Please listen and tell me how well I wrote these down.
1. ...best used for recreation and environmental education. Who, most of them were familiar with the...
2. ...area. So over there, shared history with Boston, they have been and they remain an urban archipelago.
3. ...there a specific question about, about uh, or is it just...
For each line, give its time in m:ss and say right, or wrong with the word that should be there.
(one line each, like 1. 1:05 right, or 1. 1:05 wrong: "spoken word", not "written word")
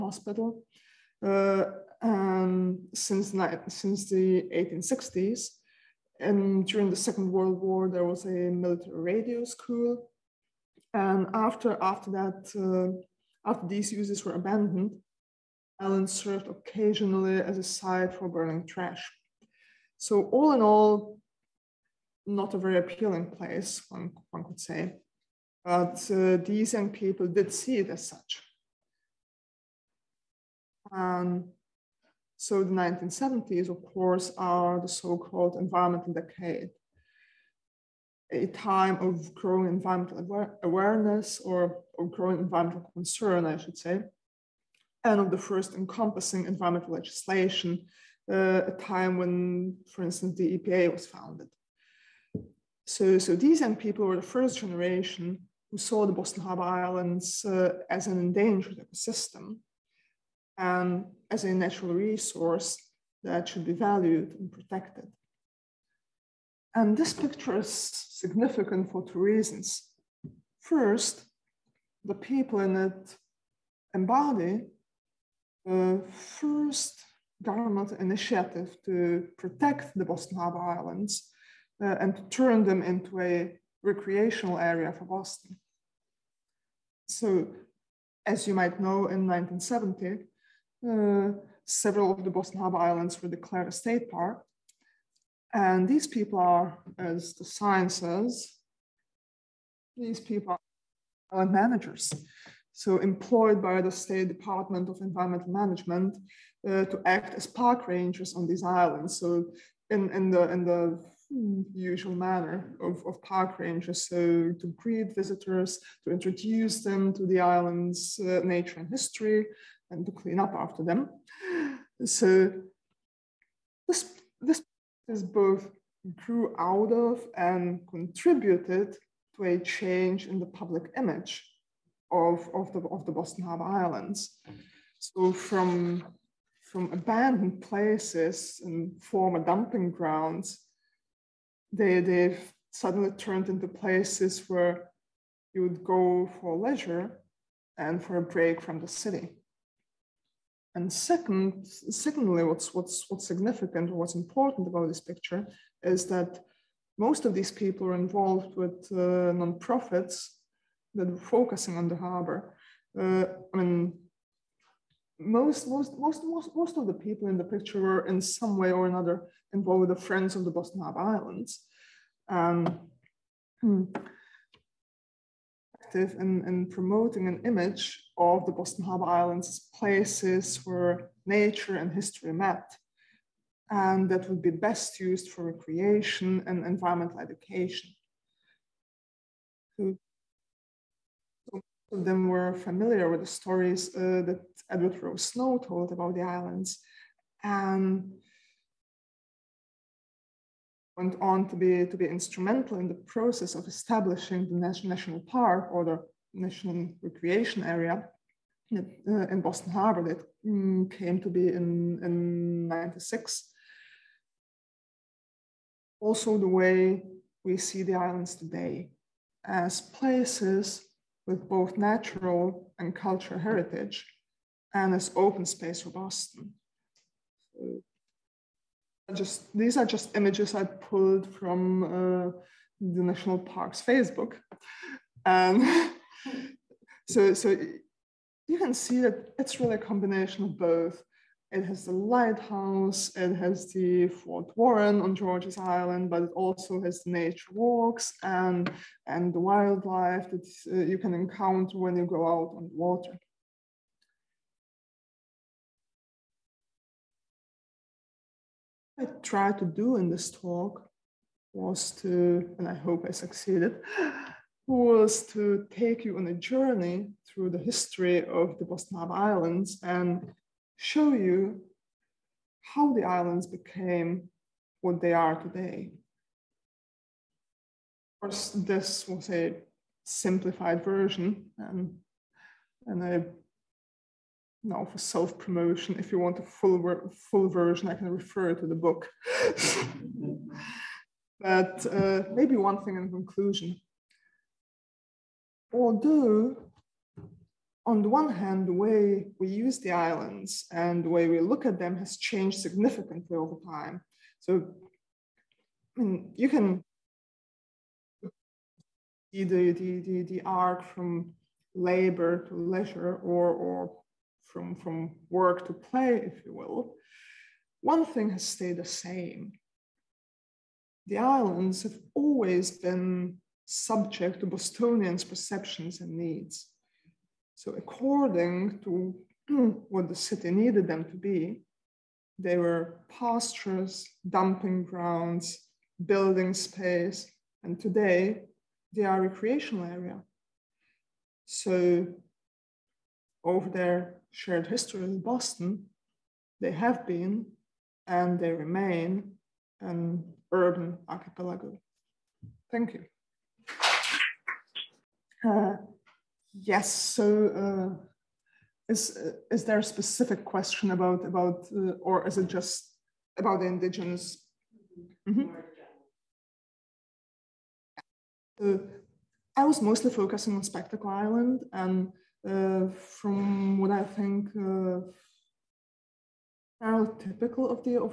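1. 3:04 right
2. 5:39 right
3. 5:59 right.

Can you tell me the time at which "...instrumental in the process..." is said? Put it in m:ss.
3:22.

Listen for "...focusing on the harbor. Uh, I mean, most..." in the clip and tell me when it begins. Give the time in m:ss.
2:41.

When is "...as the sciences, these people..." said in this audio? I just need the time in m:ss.
1:36.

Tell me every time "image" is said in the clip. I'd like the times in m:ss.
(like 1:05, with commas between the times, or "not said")
2:10, 2:57, 3:50.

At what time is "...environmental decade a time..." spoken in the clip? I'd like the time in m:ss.
0:35.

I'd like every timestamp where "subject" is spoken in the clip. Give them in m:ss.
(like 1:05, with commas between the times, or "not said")
5:23.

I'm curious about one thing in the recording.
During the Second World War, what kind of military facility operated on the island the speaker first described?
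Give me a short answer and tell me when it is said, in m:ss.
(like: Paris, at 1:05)
military radio school, at 0:08.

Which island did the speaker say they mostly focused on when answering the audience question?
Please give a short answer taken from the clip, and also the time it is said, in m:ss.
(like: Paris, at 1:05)
Spectacle Island, at 6:10.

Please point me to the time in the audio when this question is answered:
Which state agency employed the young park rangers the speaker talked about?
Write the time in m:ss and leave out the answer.
1:43.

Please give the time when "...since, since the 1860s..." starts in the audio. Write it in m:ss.
0:02.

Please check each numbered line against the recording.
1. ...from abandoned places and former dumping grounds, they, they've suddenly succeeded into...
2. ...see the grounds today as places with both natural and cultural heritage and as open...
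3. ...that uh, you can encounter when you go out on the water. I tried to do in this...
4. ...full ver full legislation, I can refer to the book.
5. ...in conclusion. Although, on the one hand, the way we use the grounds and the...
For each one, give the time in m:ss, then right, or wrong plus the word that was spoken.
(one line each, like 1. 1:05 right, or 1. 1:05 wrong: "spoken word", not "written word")
1. 2:16 wrong: "turned", not "succeeded"
2. 3:37 wrong: "islands", not "grounds"
3. 4:10 right
4. 4:46 wrong: "version", not "legislation"
5. 4:52 wrong: "islands", not "grounds".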